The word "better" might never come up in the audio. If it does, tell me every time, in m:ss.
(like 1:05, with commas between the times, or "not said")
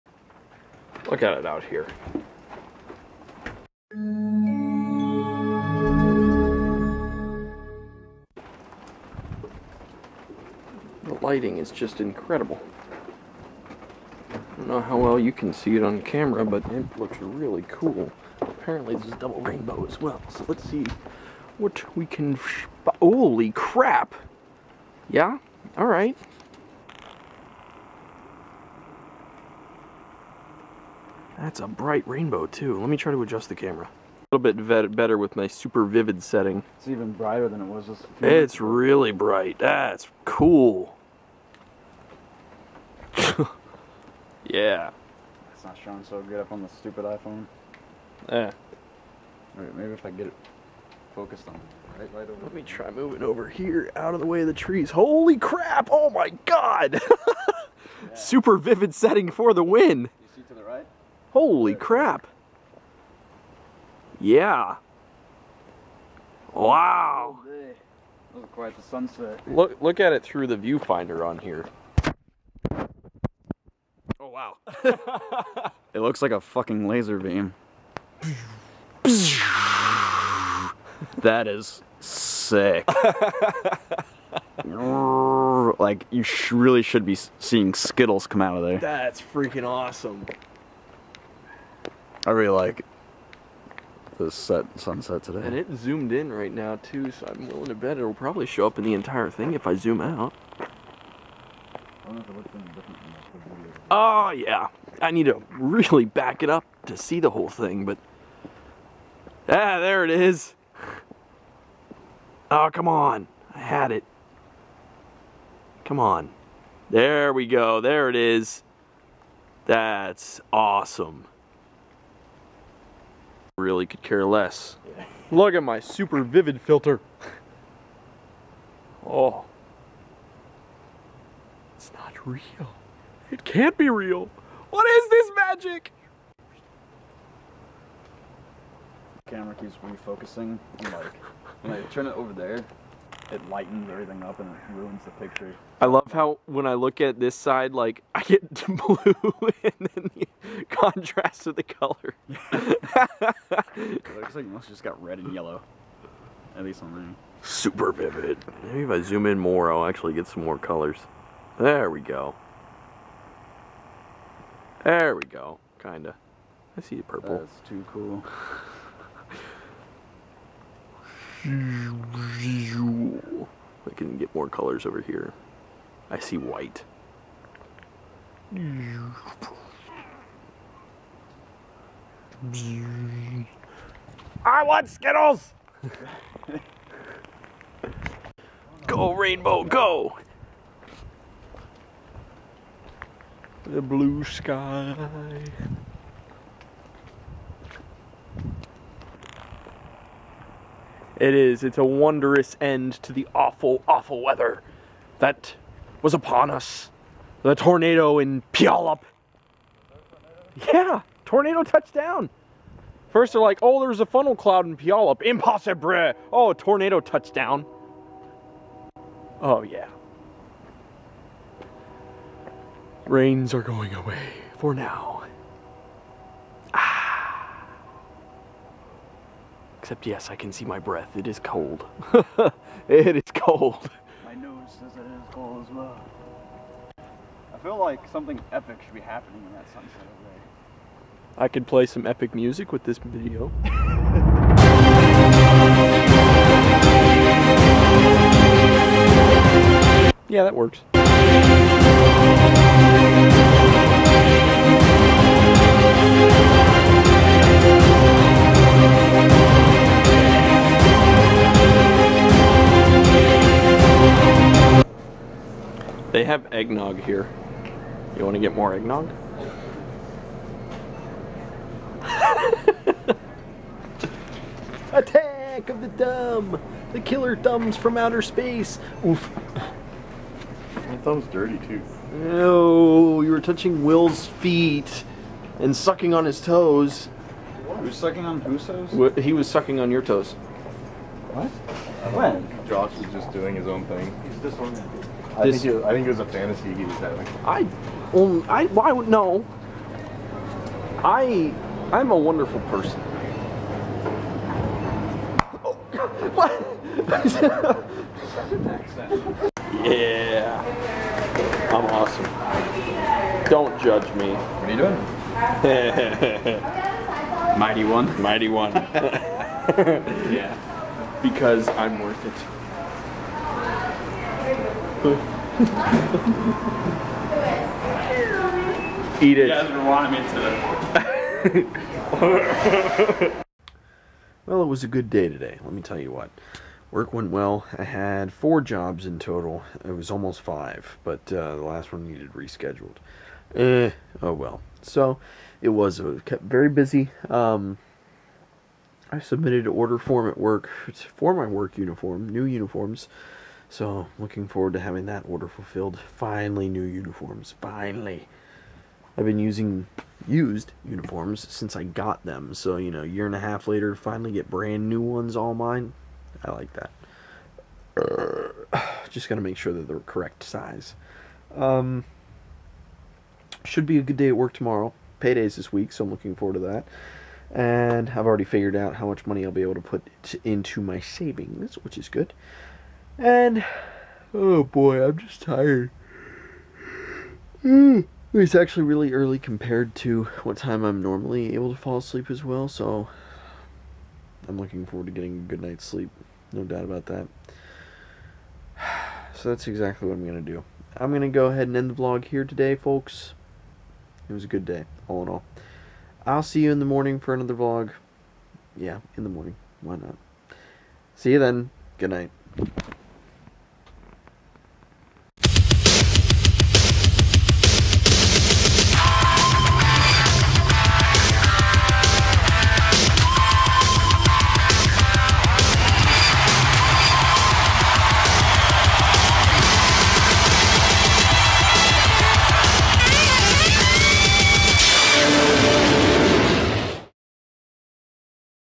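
0:34.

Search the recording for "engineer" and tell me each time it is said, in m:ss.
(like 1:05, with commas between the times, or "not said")
not said.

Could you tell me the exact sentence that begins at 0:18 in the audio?
Apparently this is double rainbow as well, so let's see what we can...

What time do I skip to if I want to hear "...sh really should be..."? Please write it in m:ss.
1:26.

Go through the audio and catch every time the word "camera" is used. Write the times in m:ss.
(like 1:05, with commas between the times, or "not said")
0:16, 0:33, 2:19.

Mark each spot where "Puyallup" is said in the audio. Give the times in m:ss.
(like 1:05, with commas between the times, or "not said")
3:28, 3:34.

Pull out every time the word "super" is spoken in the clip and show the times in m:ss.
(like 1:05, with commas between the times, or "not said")
0:35, 0:58, 2:05, 2:37.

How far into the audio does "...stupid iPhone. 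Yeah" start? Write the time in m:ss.
0:46.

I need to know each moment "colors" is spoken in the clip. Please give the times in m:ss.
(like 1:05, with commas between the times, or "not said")
2:31, 2:40, 2:54.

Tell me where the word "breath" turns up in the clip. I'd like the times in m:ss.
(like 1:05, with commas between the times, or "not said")
3:50.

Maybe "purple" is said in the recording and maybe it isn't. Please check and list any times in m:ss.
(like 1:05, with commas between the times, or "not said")
2:47.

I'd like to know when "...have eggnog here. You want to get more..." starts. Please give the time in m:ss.
4:26.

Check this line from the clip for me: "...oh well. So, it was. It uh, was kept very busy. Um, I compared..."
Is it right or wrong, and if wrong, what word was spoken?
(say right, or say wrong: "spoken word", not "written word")
wrong: "submitted", not "compared".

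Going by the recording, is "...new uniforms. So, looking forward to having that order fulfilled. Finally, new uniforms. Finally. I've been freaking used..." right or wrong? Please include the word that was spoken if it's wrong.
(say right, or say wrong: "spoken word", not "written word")
wrong: "using", not "freaking".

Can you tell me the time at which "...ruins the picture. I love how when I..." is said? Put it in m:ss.
2:24.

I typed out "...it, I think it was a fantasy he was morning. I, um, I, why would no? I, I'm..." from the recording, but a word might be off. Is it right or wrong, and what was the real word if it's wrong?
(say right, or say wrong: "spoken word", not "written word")
wrong: "having", not "morning".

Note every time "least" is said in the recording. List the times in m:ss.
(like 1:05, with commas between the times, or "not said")
2:36.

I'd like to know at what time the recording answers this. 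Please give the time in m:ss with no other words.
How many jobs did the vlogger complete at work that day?
5:38.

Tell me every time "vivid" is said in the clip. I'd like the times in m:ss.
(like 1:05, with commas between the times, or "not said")
0:35, 0:58, 2:06, 2:37.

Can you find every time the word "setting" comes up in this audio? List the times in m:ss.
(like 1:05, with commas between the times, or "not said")
0:36, 0:58.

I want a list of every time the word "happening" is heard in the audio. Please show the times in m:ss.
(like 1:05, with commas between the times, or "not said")
3:58.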